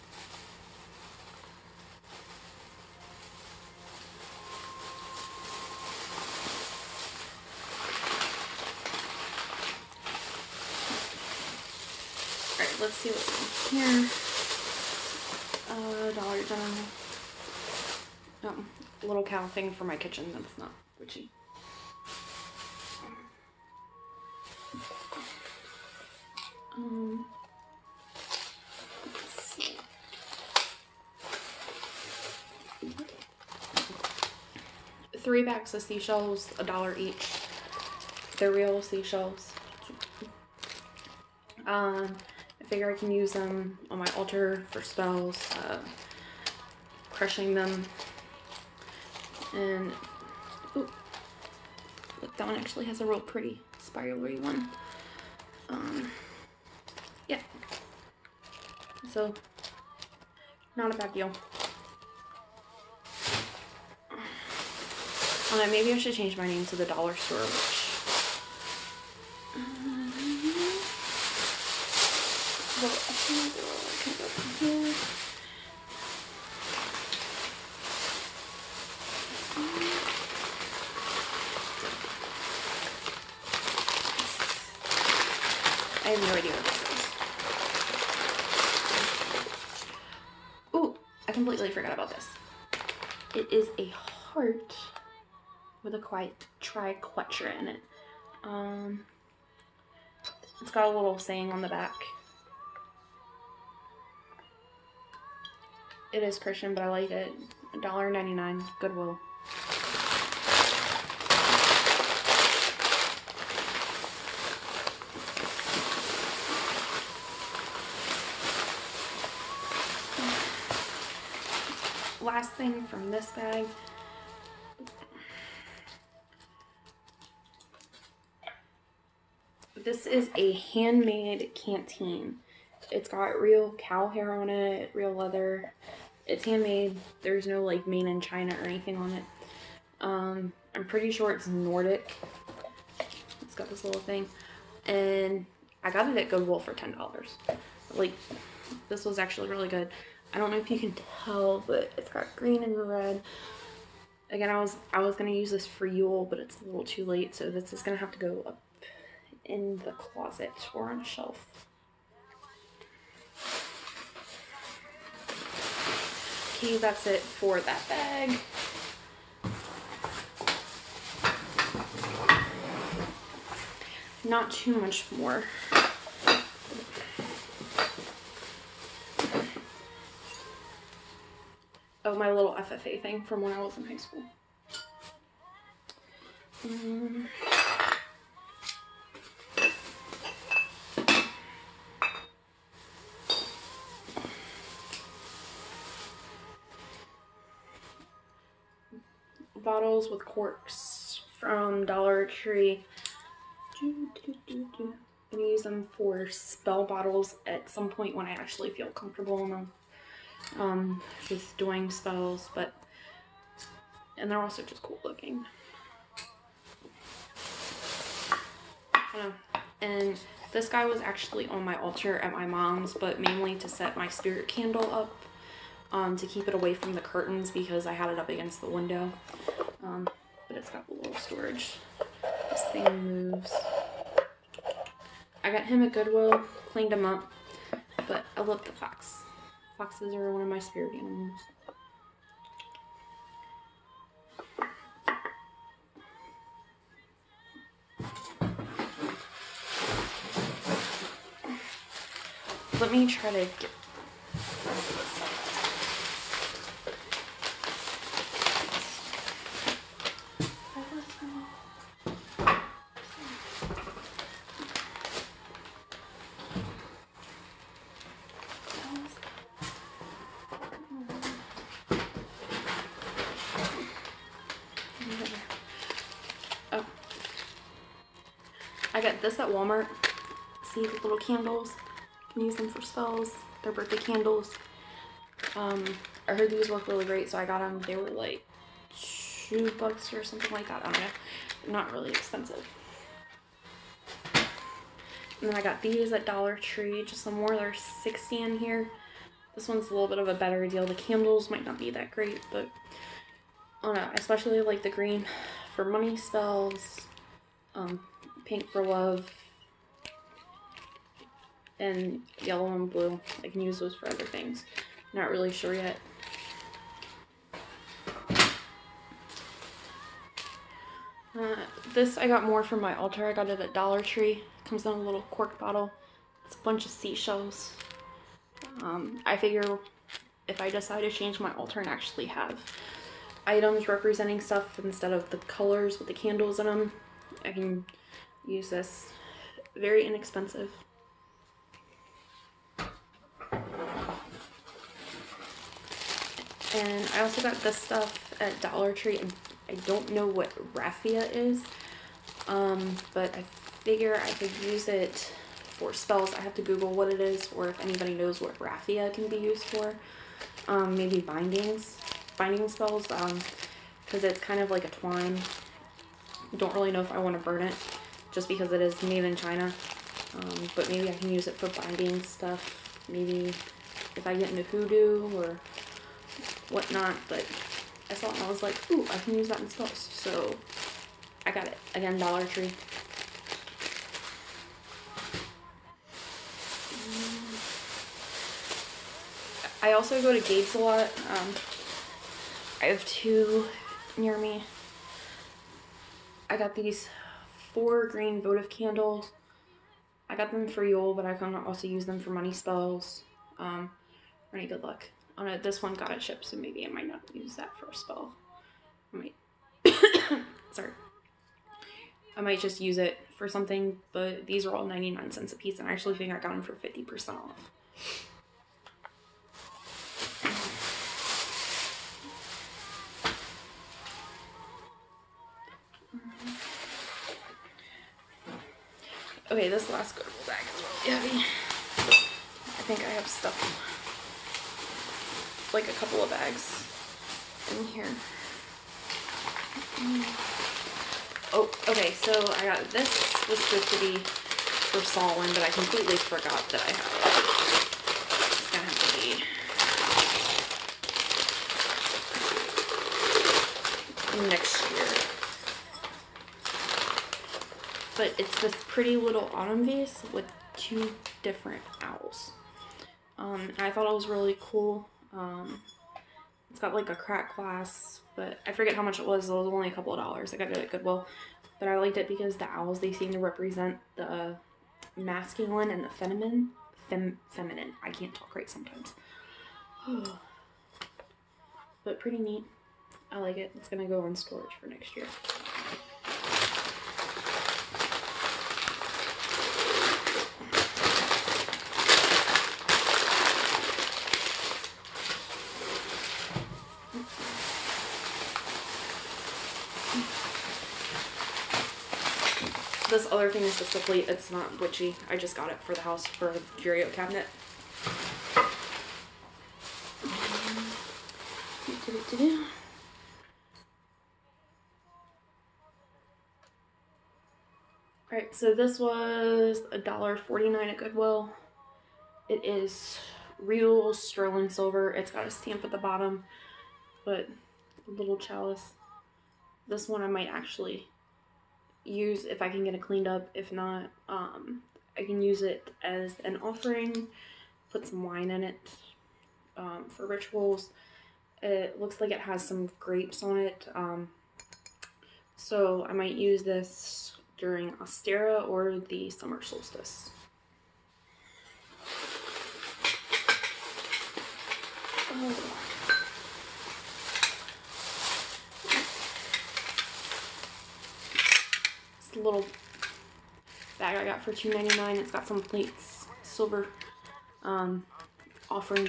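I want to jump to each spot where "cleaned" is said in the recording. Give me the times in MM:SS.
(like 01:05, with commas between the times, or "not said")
03:56, 08:53.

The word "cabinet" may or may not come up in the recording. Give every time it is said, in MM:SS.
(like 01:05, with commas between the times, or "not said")
08:27.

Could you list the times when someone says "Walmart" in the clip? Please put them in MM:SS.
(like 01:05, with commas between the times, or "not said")
04:39.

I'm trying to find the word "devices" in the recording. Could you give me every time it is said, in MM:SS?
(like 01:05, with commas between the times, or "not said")
not said.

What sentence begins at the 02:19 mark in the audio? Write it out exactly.
Um, I'm pretty sure it's Nordic.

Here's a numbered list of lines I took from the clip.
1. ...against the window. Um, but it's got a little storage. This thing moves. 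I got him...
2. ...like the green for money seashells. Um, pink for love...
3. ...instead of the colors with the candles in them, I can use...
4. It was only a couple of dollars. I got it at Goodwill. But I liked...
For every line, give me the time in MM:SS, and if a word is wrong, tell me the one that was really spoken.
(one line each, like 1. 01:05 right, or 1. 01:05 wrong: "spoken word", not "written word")
1. 03:48 right
2. 05:04 wrong: "spells", not "seashells"
3. 05:34 right
4. 07:49 right.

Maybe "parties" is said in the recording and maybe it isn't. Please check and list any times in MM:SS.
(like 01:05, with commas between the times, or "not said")
not said.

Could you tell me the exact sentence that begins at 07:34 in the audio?
It's gonna have to be next But it's this pretty little autumn vase with two different owls.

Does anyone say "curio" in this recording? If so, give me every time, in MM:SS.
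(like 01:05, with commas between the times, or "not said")
08:26.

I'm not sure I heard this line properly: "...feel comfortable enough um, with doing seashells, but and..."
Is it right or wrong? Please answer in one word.
wrong.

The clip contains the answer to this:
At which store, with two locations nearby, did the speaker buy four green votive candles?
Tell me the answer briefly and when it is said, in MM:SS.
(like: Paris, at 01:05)
Gabe's, at 06:30.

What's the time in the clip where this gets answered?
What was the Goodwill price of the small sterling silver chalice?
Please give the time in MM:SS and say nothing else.
08:39.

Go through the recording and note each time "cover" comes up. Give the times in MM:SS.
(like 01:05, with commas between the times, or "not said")
not said.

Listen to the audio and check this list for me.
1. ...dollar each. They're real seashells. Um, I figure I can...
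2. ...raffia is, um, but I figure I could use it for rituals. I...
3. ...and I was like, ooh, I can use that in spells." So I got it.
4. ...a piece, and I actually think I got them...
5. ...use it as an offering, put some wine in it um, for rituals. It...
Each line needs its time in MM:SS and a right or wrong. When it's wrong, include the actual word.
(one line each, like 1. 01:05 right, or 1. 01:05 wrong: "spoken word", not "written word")
1. 00:36 right
2. 05:50 wrong: "spells", not "rituals"
3. 06:18 right
4. 06:55 right
5. 08:55 right.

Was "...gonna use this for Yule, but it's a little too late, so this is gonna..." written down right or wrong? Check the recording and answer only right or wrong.
right.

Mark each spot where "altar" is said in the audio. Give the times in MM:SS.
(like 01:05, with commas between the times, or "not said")
00:44, 03:41, 05:22, 05:31.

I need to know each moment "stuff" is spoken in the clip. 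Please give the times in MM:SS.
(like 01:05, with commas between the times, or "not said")
05:34, 05:47, 06:12, 07:13.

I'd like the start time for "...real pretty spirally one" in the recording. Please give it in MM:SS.
00:53.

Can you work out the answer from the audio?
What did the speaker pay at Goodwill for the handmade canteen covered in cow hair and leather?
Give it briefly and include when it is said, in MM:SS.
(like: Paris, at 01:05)
$10, at 02:26.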